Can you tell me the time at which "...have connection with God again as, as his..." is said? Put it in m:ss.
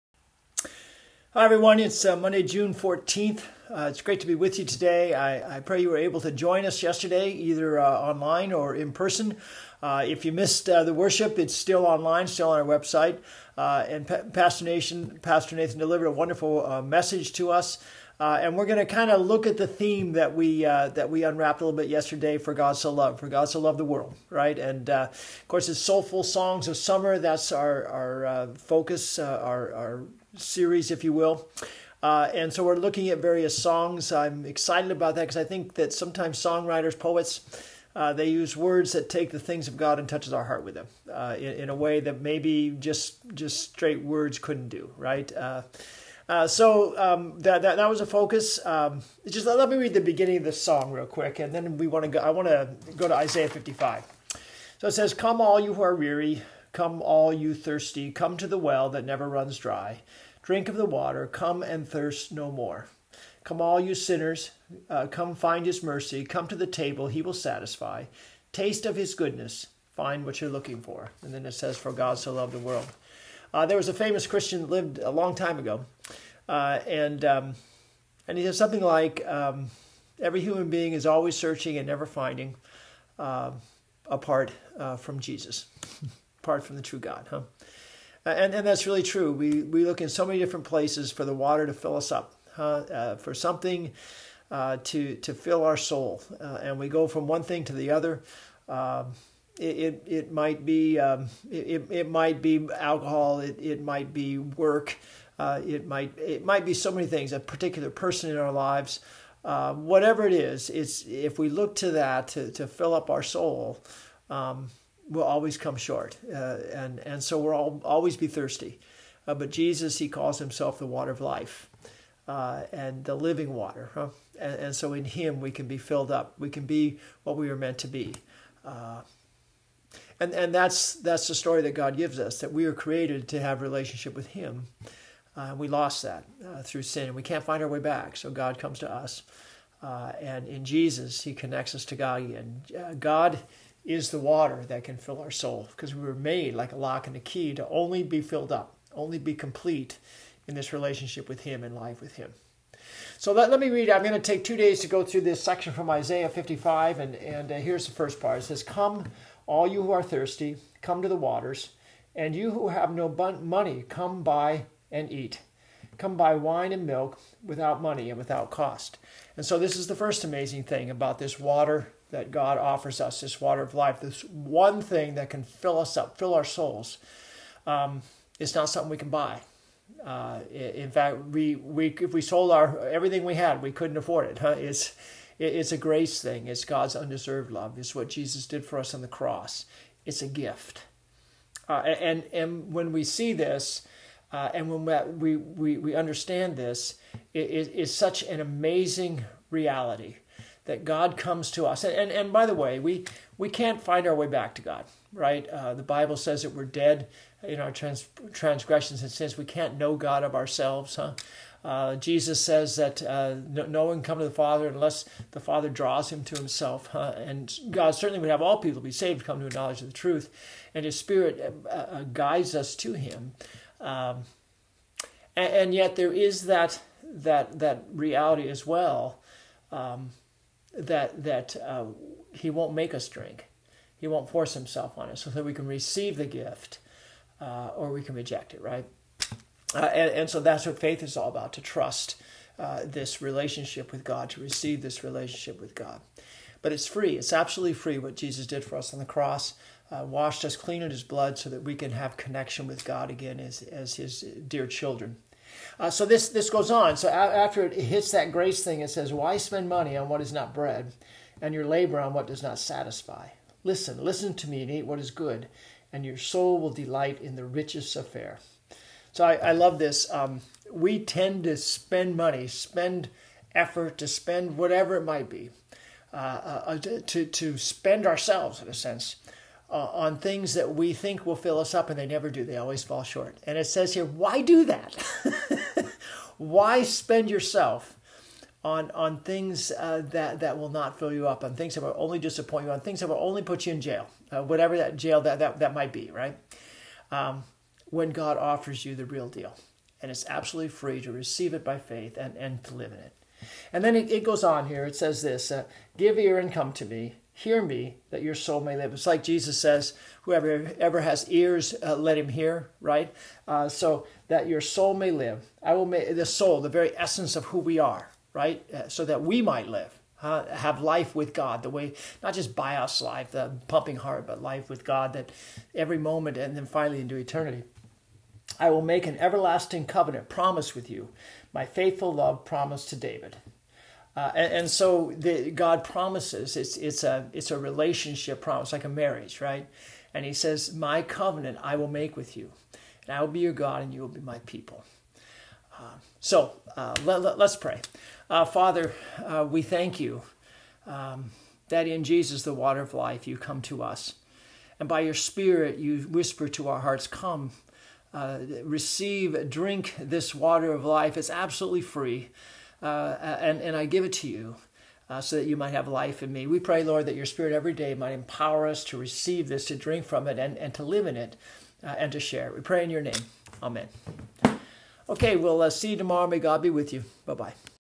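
4:11.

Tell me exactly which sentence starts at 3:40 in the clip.
And his Spirit uh, uh guides us to him.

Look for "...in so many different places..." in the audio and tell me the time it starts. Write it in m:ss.
1:30.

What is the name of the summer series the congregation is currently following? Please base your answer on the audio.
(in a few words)
Soulful Songs of Summer.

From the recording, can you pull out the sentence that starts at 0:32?
Uh, and so we're looking at various songs.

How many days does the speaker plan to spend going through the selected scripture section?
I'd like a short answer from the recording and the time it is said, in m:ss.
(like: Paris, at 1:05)
2, at 2:34.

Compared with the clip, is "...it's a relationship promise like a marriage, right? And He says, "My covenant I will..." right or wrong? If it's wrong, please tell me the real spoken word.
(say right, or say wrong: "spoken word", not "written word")
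right.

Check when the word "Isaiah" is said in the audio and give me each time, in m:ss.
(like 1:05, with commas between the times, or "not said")
0:53, 2:35.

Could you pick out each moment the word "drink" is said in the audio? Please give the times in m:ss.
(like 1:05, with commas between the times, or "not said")
1:00, 3:53, 5:59, 6:09.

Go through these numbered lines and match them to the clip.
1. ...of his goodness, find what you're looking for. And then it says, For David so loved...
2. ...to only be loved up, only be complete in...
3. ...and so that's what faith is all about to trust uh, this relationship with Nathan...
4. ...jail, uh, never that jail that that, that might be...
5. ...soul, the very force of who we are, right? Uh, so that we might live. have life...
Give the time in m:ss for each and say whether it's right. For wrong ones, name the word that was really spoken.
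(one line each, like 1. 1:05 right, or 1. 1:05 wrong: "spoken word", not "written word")
1. 1:08 wrong: "God", not "David"
2. 2:27 wrong: "filled", not "loved"
3. 4:00 wrong: "God", not "Nathan"
4. 4:53 wrong: "whatever", not "never"
5. 5:16 wrong: "essence", not "force".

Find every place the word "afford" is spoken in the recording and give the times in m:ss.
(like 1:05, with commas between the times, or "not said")
3:03.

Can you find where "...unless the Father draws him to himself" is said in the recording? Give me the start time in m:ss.
3:34.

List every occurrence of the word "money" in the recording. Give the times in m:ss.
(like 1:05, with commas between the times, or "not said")
2:43, 2:47, 4:19, 4:32.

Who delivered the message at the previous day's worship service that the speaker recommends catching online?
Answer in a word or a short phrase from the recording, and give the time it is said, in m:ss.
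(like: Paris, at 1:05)
Pastor Nathan, at 0:15.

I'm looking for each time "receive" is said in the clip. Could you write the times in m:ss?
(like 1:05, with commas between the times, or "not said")
3:55, 4:04, 5:01, 5:58, 6:08.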